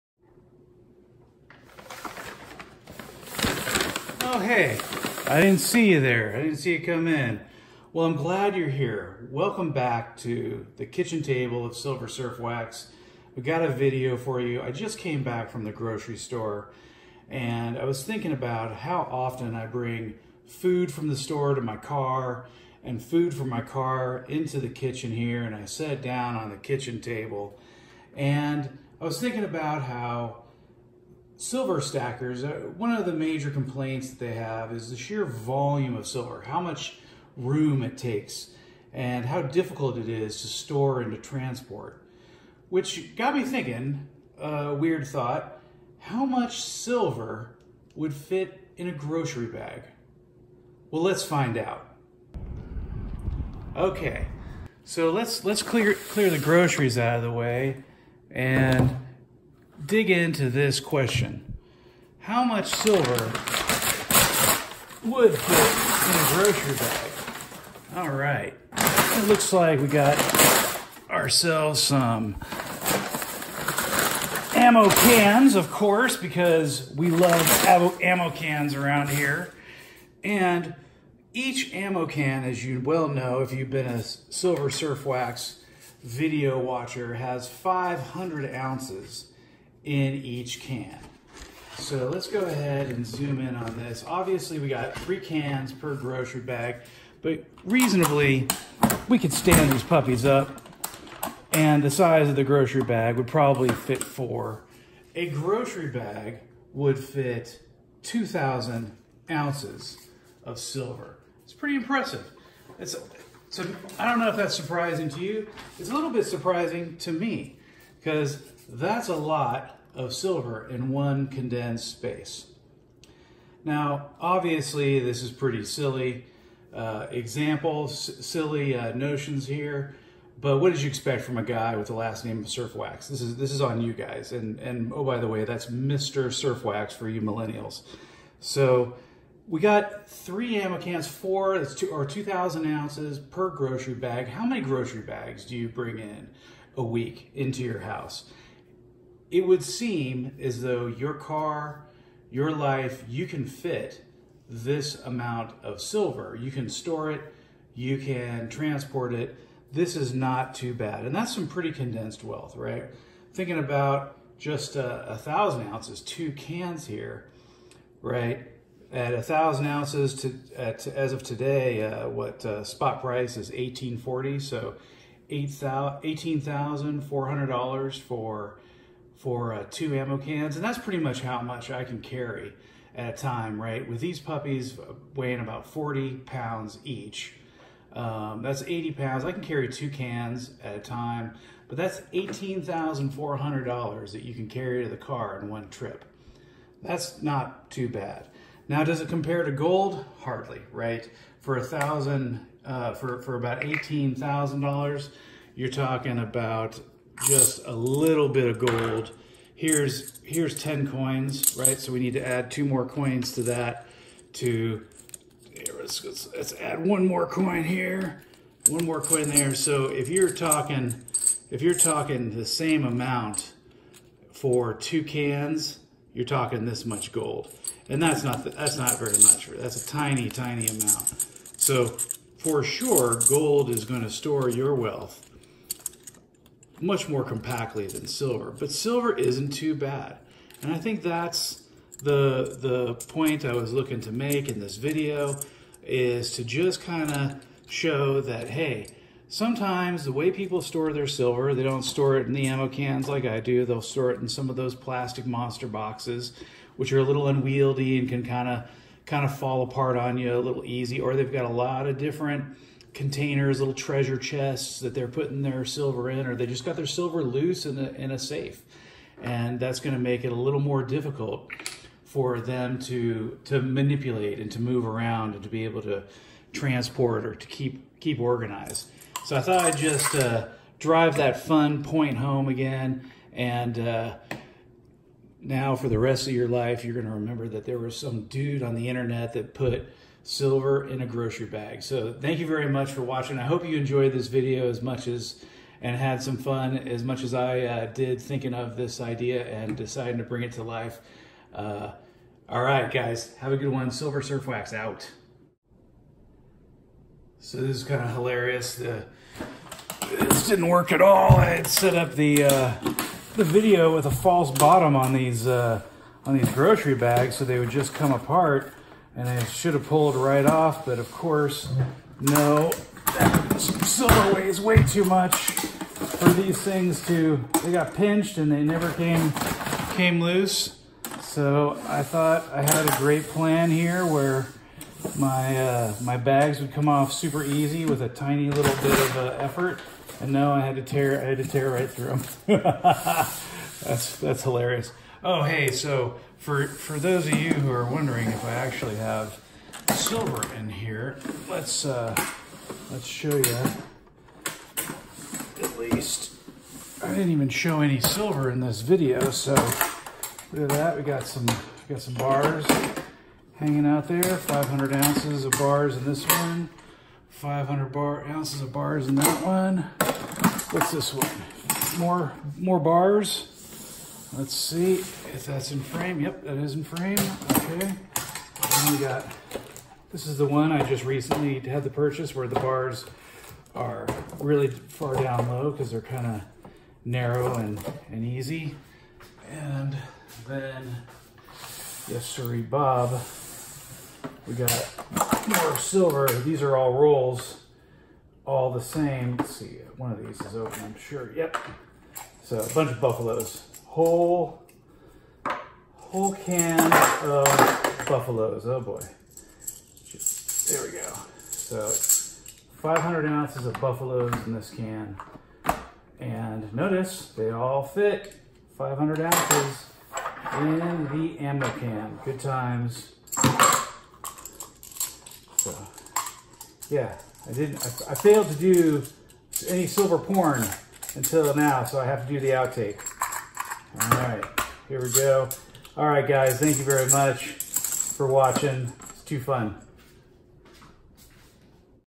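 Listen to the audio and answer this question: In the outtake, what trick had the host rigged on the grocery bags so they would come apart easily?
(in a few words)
False bottom.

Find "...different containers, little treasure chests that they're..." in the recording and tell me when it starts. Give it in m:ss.
4:21.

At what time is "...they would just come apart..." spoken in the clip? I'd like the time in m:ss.
5:17.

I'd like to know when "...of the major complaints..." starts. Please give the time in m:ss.
0:32.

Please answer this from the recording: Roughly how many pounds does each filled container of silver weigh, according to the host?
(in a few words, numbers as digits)
40 pounds.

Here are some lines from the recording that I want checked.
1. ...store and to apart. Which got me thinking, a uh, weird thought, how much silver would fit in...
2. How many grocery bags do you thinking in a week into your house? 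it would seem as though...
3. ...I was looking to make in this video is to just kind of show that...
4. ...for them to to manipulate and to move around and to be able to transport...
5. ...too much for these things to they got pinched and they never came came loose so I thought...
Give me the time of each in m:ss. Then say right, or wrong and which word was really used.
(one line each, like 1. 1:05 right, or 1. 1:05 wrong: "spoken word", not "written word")
1. 0:40 wrong: "transport", not "apart"
2. 2:24 wrong: "bring", not "thinking"
3. 4:03 right
4. 4:32 right
5. 5:24 right.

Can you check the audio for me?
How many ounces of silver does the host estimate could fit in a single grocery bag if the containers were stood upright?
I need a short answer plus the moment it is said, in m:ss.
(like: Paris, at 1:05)
2,000 ounces, at 1:48.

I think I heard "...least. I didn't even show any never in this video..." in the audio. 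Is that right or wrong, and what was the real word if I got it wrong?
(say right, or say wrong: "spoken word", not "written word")
wrong: "silver", not "never".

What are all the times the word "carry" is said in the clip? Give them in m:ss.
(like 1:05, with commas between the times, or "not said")
3:02, 3:09, 3:14.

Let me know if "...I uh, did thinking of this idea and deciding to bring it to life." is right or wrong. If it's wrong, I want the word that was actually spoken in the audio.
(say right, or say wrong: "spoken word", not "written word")
right.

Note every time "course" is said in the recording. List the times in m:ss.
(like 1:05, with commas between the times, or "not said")
1:15, 5:21.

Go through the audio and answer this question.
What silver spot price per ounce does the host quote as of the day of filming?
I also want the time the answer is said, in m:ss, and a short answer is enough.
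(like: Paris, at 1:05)
$18.40, at 2:53.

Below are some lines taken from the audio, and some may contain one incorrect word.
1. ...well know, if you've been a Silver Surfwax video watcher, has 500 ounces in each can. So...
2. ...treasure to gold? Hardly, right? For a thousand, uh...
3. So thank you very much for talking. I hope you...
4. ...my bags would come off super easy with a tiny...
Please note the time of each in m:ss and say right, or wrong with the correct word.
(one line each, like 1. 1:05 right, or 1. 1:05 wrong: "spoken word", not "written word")
1. 1:22 right
2. 3:19 wrong: "compare", not "treasure"
3. 4:51 wrong: "watching", not "talking"
4. 5:36 right.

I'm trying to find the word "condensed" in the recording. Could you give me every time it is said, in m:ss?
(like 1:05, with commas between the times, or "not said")
2:01, 2:41.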